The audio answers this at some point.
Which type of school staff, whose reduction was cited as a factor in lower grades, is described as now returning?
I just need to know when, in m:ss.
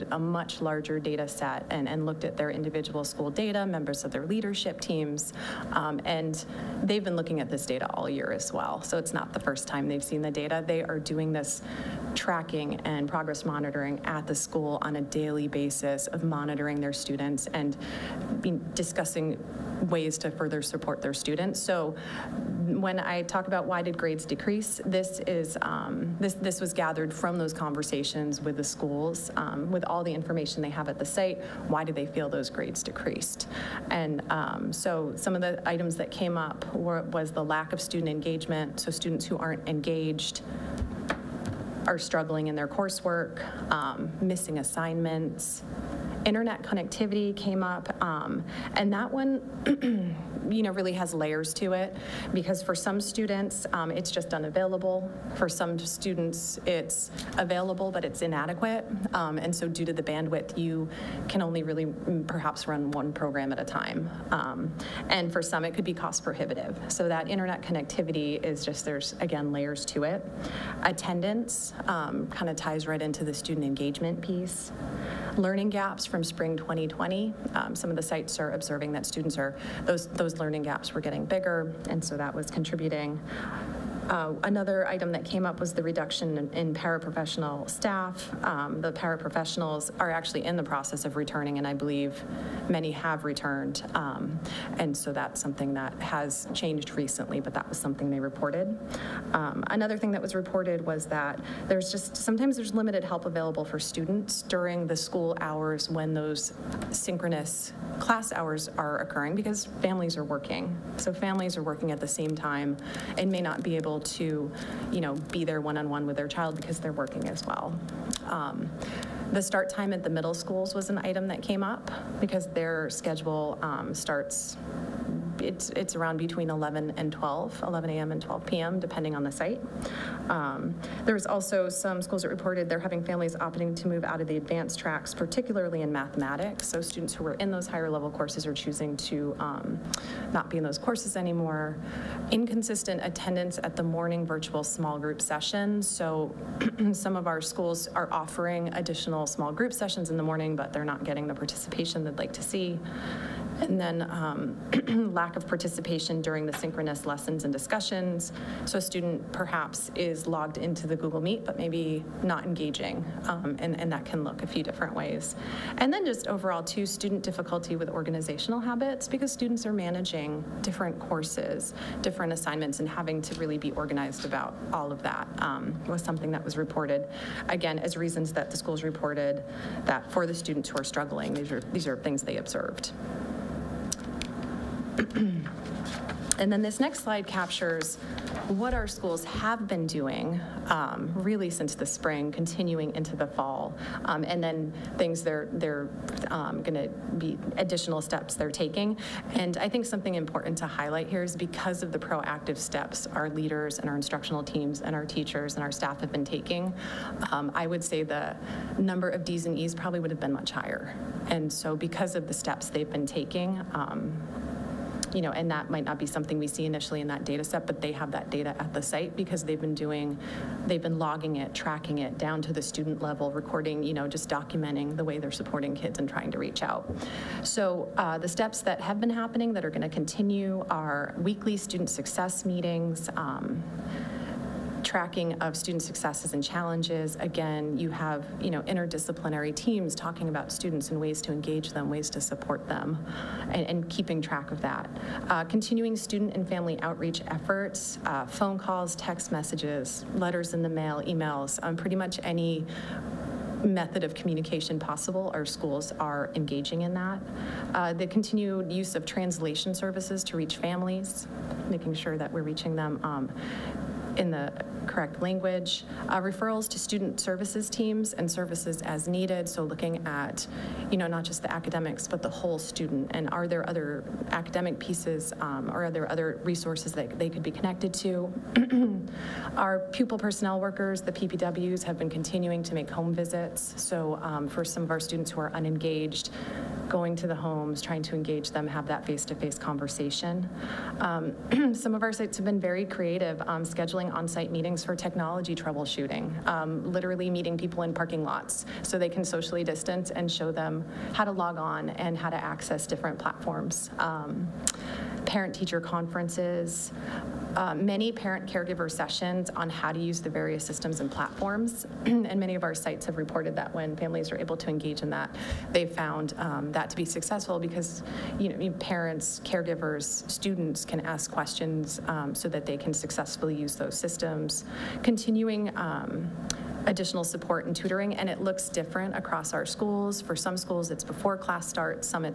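1:26.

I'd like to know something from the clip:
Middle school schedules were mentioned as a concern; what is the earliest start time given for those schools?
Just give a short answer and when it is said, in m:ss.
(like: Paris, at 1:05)
11 a.m., at 2:07.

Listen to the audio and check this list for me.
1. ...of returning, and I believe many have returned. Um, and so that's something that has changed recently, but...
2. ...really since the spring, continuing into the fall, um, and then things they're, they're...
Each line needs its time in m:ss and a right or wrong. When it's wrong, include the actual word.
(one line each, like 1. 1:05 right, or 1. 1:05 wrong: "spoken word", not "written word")
1. 1:31 right
2. 3:11 right.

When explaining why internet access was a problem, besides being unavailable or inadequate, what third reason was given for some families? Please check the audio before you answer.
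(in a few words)
Cost prohibitive.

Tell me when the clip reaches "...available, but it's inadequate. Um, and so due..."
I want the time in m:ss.
0:57.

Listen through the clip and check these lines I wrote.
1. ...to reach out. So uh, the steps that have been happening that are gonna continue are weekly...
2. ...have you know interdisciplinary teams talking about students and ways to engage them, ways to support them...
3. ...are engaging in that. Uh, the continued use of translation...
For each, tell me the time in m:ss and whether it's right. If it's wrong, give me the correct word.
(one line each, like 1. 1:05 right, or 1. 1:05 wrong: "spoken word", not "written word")
1. 3:46 right
2. 3:57 right
3. 4:15 right.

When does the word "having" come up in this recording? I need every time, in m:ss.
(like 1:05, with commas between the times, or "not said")
2:12, 2:52.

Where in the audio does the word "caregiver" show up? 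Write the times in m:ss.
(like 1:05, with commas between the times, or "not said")
5:08, 5:19.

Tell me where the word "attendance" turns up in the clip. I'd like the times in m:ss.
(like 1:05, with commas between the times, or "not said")
1:10, 2:23.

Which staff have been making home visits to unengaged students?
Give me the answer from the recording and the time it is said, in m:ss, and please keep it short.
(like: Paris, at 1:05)
Pupil personnel workers, at 4:39.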